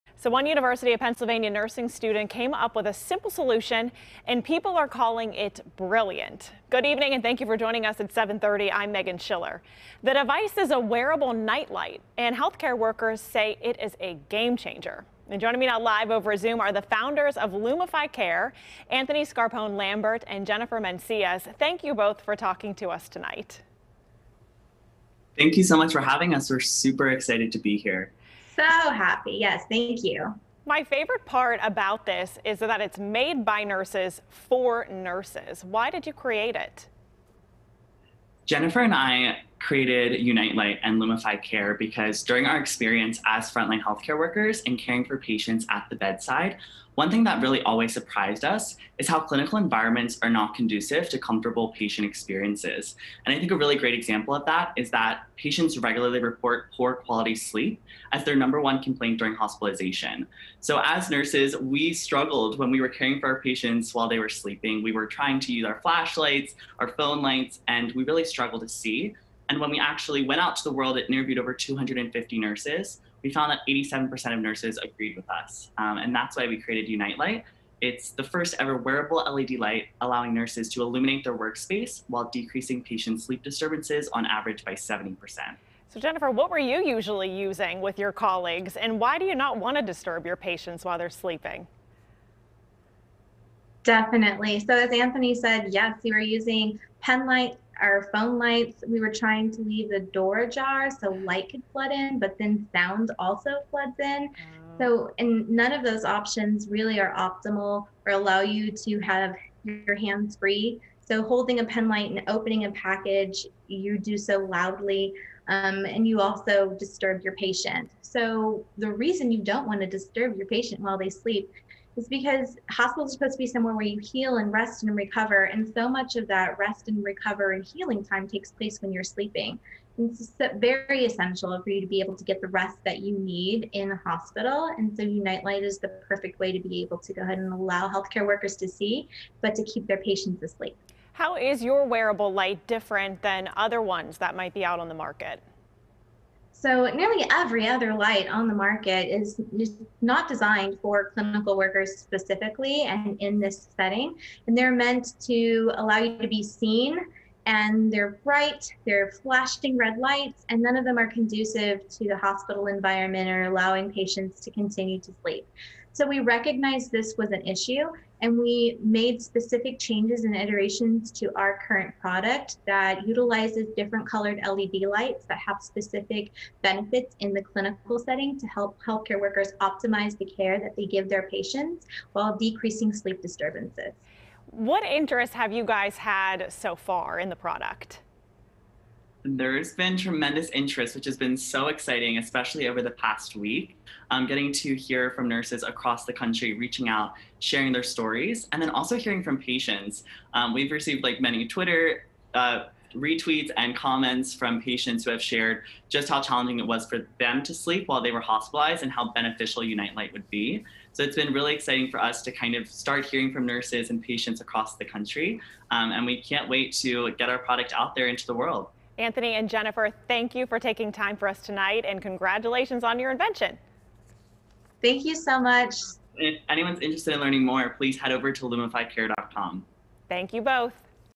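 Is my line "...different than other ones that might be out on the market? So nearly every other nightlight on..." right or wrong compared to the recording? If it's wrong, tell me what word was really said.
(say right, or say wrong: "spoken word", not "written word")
wrong: "light", not "nightlight".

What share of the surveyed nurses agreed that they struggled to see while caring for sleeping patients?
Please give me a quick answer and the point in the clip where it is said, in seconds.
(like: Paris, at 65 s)
87%, at 73 s.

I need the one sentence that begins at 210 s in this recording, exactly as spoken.
So it's been really exciting for us to kind of start hearing from nurses and patients across the country.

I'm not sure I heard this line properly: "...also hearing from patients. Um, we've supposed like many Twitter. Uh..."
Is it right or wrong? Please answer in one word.
wrong.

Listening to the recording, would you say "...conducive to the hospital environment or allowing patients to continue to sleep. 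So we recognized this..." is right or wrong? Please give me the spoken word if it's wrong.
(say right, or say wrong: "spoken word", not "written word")
right.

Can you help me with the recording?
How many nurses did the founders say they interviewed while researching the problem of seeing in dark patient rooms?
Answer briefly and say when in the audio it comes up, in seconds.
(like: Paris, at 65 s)
250, at 71 s.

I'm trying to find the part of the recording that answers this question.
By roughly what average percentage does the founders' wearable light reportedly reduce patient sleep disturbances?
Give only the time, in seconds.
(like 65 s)
84 s.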